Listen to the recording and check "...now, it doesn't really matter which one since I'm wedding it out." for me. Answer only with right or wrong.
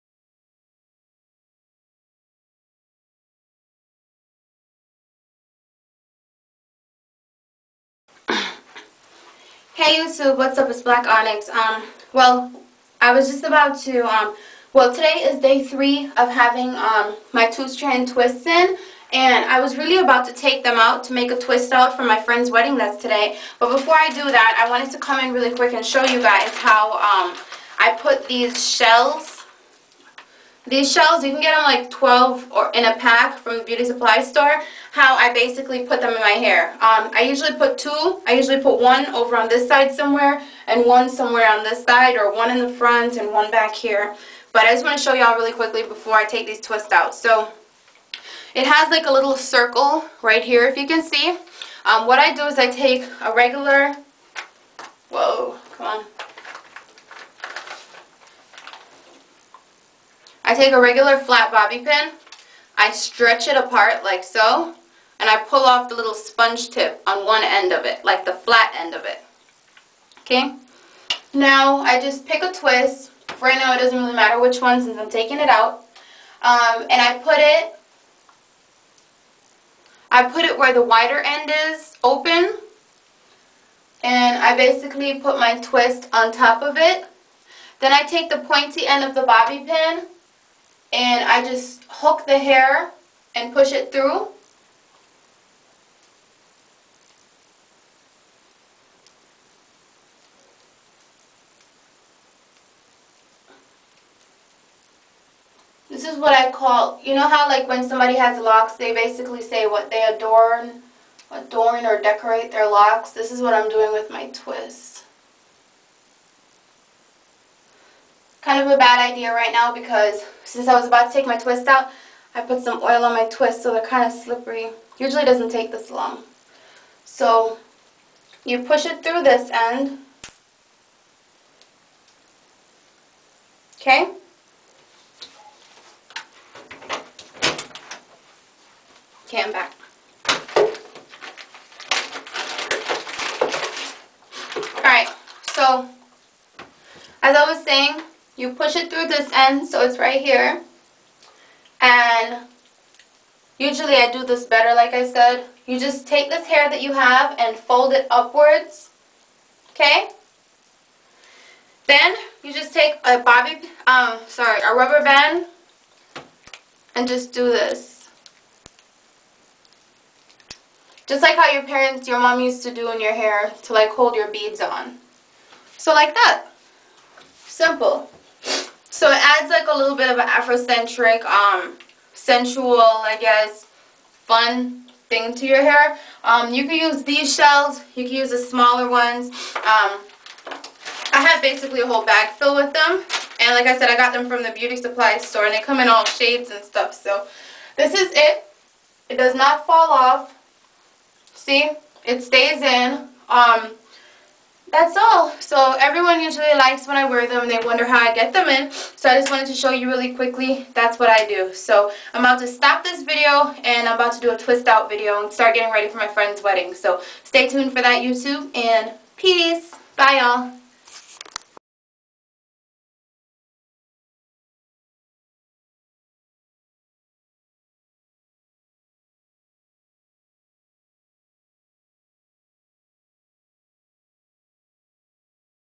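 wrong.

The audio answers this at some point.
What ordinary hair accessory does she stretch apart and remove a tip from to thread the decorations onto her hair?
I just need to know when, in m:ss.
1:01.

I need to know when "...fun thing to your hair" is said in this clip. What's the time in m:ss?
3:04.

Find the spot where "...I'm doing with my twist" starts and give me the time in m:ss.
1:53.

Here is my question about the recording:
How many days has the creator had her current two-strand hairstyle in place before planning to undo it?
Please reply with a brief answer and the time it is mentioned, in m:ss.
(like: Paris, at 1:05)
3, at 0:15.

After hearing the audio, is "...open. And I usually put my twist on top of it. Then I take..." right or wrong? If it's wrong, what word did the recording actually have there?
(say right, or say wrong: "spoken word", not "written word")
wrong: "basically", not "usually".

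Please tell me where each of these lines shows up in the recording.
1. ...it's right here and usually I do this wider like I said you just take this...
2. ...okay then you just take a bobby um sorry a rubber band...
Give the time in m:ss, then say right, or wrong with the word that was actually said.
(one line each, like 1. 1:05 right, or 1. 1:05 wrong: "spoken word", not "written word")
1. 2:29 wrong: "better", not "wider"
2. 2:39 right.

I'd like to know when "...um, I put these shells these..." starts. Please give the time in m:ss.
0:26.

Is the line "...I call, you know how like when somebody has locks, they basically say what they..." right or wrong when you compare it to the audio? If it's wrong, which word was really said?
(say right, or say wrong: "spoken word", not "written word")
right.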